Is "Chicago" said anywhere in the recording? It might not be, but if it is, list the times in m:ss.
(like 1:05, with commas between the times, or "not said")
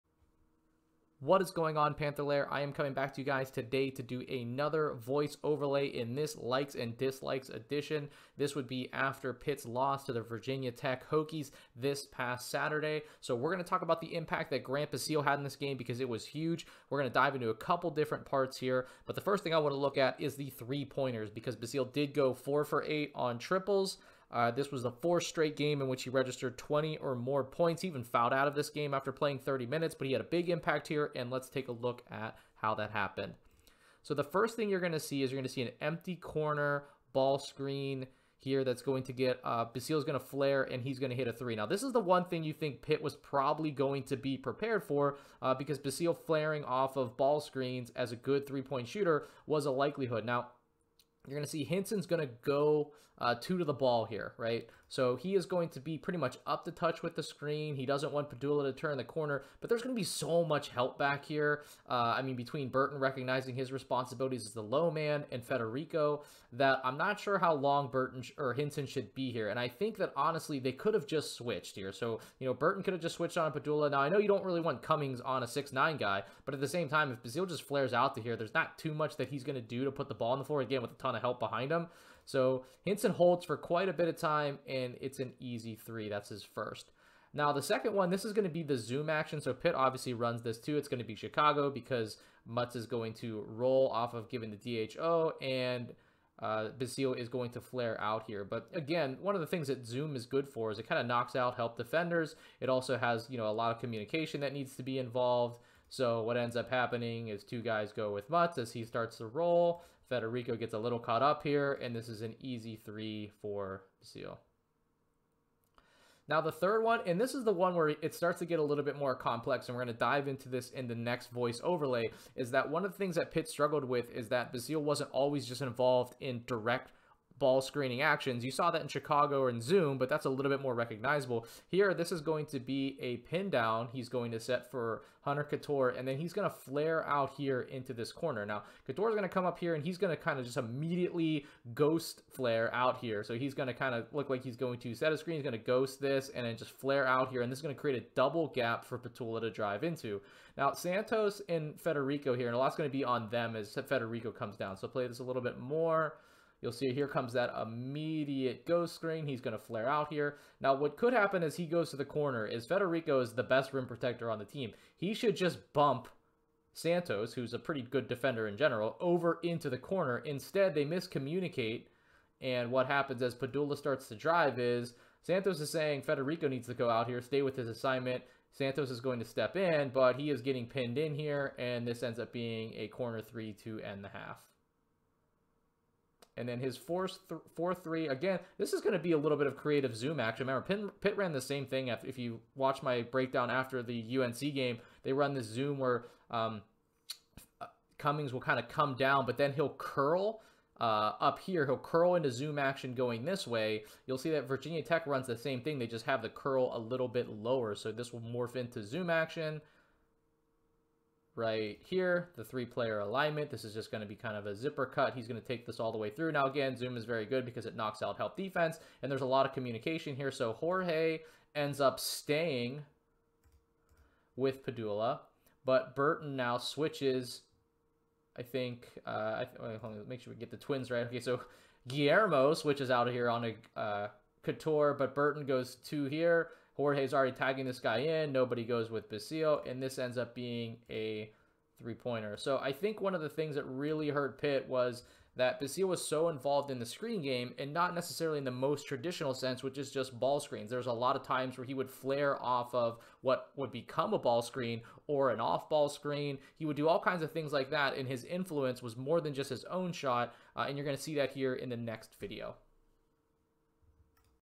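1:31, 2:08.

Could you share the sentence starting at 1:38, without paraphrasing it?
But again, one of the things that Zoom is good for is it kind of knocks out help defenders.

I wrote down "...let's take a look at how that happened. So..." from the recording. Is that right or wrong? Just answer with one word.
right.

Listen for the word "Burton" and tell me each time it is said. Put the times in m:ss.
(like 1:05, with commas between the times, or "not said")
1:02, 1:07, 1:12, 3:45, 3:55.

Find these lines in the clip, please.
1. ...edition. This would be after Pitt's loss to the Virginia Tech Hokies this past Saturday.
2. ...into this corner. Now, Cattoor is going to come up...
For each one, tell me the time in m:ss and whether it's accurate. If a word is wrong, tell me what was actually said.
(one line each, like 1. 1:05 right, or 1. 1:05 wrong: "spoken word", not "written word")
1. 0:07 right
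2. 2:17 right.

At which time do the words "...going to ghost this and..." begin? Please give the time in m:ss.
2:25.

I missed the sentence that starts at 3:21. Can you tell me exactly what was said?
He'll curl into zoom action going this way.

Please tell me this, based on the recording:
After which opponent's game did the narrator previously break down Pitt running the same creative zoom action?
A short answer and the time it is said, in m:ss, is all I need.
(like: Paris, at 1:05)
UNC, at 3:14.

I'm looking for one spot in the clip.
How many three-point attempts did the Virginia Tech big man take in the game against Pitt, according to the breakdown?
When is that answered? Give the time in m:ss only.
0:22.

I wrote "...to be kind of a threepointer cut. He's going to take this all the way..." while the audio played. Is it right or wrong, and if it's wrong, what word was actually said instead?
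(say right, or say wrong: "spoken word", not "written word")
wrong: "zipper", not "threepointer".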